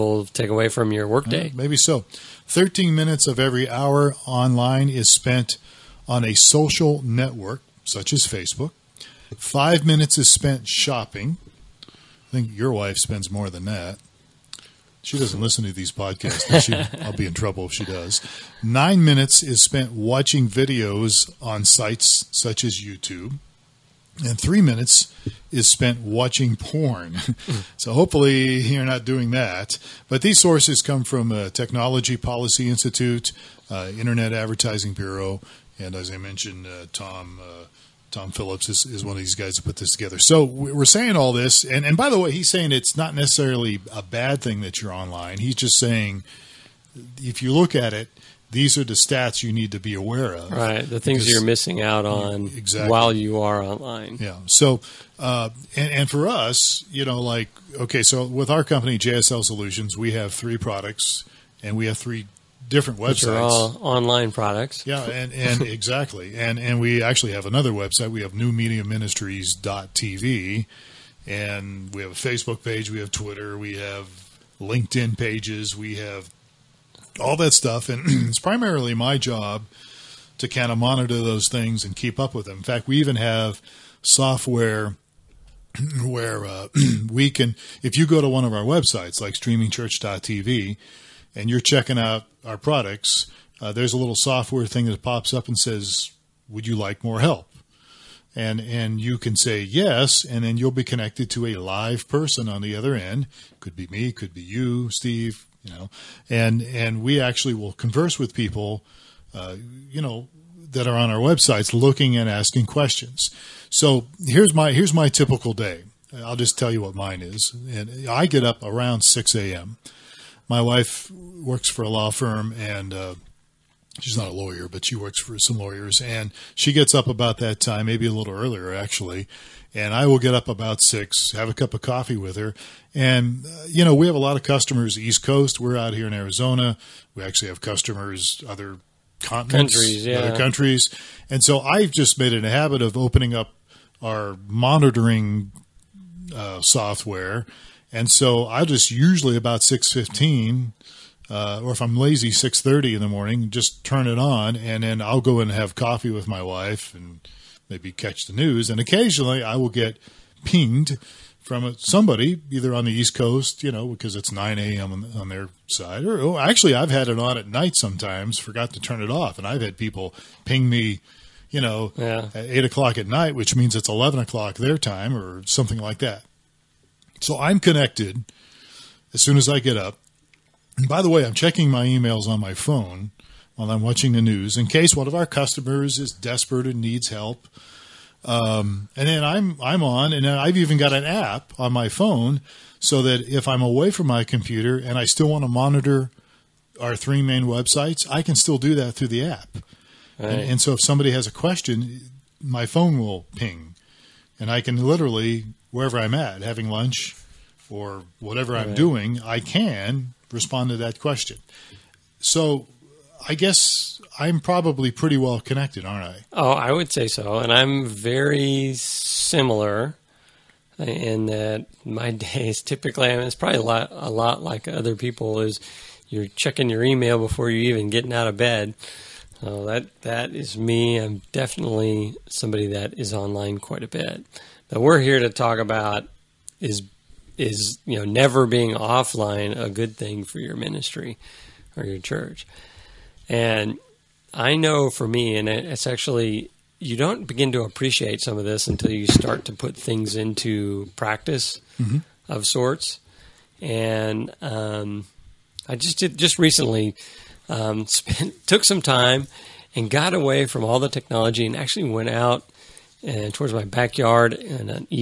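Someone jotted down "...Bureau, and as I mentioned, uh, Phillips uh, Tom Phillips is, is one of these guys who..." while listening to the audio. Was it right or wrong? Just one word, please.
wrong.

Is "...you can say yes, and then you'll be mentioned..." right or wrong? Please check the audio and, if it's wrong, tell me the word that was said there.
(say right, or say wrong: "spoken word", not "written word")
wrong: "connected", not "mentioned".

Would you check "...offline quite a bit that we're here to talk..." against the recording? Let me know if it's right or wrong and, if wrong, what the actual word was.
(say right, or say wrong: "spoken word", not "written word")
wrong: "online", not "offline".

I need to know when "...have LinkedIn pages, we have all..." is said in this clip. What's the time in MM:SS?
01:13.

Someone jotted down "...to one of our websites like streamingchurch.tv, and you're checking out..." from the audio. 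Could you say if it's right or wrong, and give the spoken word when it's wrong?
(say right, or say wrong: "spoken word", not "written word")
right.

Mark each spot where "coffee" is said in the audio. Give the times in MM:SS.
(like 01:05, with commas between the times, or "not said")
02:11, 02:35.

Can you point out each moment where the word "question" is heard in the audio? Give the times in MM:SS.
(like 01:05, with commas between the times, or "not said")
01:52, 03:21, 03:31.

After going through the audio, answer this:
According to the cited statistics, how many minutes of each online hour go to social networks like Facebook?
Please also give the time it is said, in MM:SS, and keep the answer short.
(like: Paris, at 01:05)
13, at 00:02.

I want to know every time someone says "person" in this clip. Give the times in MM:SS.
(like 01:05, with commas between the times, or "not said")
01:42.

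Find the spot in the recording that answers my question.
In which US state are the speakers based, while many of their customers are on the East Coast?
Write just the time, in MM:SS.
02:16.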